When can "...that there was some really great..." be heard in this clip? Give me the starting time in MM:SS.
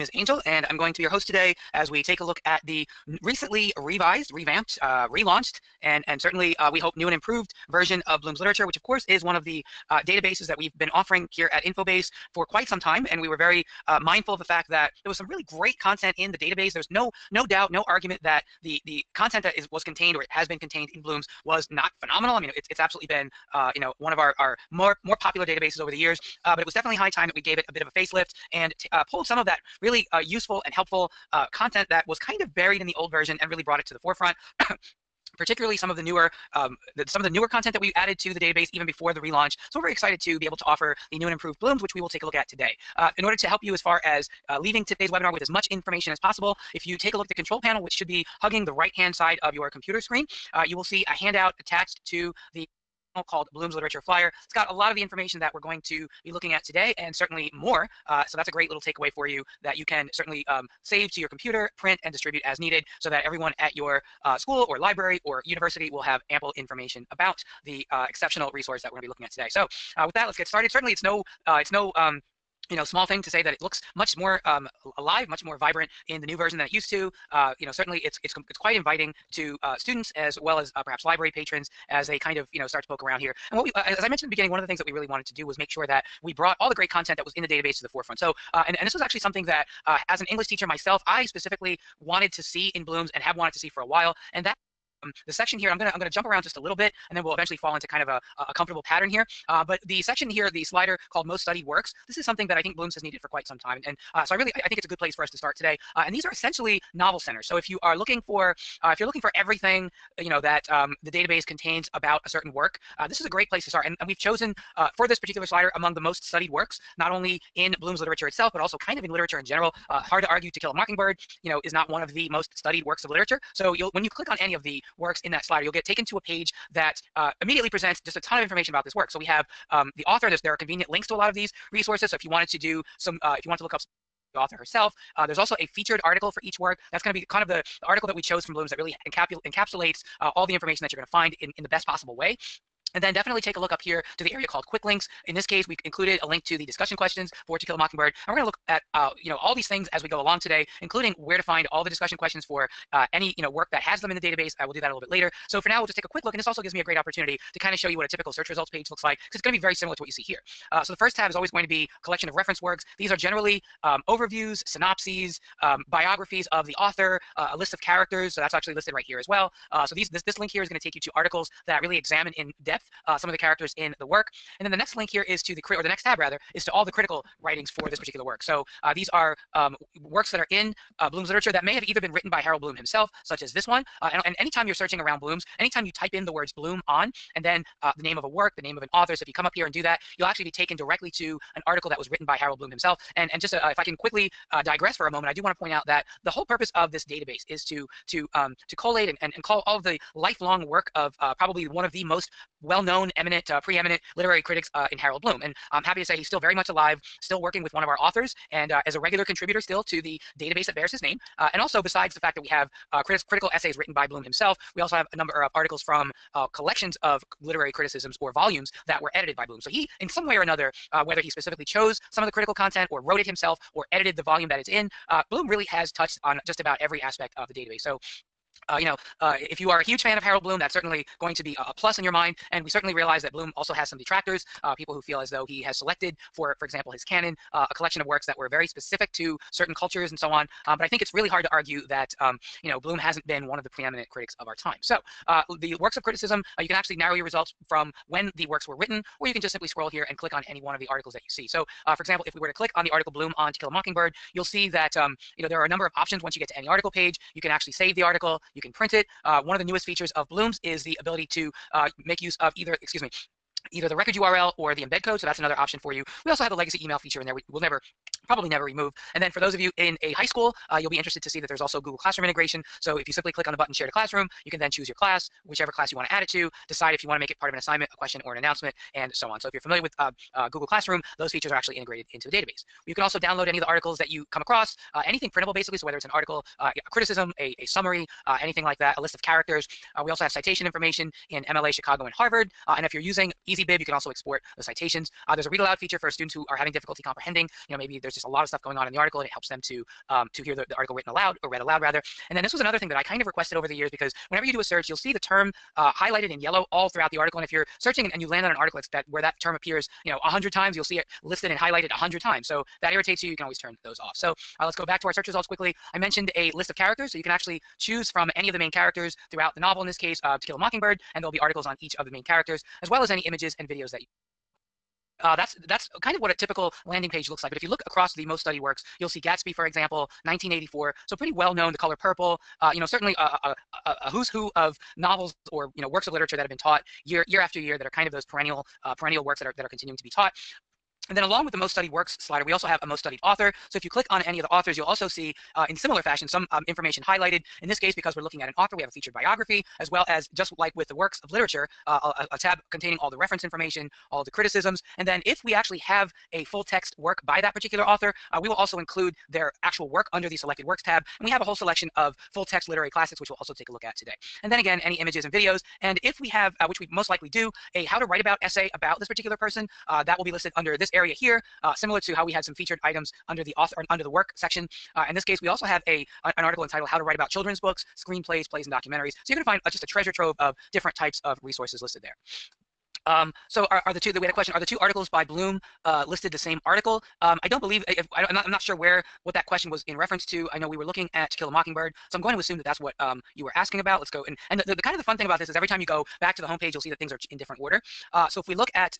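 00:14.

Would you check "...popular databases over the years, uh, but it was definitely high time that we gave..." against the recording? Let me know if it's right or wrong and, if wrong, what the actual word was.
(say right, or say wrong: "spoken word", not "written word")
right.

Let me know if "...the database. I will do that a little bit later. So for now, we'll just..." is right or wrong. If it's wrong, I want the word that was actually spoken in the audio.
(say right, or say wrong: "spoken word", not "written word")
right.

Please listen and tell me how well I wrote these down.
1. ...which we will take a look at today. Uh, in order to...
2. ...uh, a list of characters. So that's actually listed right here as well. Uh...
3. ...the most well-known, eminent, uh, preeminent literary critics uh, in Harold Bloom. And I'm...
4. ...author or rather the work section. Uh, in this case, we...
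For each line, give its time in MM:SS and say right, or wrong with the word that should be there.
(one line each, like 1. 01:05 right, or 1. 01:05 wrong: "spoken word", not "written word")
1. 00:41 right
2. 02:47 right
3. 03:21 right
4. 06:13 wrong: "under", not "rather".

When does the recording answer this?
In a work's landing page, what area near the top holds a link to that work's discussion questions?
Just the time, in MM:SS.
02:24.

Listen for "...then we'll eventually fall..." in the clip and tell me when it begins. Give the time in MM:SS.
01:37.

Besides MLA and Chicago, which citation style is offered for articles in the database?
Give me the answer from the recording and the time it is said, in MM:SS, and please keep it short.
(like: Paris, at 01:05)
Harvard, at 04:52.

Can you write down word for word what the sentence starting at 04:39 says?
So if you're familiar with uh, uh, Google Classroom, those features are actually integrated into the database.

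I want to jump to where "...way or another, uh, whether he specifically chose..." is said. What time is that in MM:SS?
03:40.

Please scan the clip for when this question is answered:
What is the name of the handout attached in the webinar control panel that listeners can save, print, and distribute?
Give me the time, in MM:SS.
00:53.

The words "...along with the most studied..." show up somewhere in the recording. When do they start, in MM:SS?
05:41.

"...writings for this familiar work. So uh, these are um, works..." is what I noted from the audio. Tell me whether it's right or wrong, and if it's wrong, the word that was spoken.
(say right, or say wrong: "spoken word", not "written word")
wrong: "particular", not "familiar".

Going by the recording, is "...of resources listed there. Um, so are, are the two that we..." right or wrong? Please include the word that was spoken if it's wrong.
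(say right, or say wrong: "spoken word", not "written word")
right.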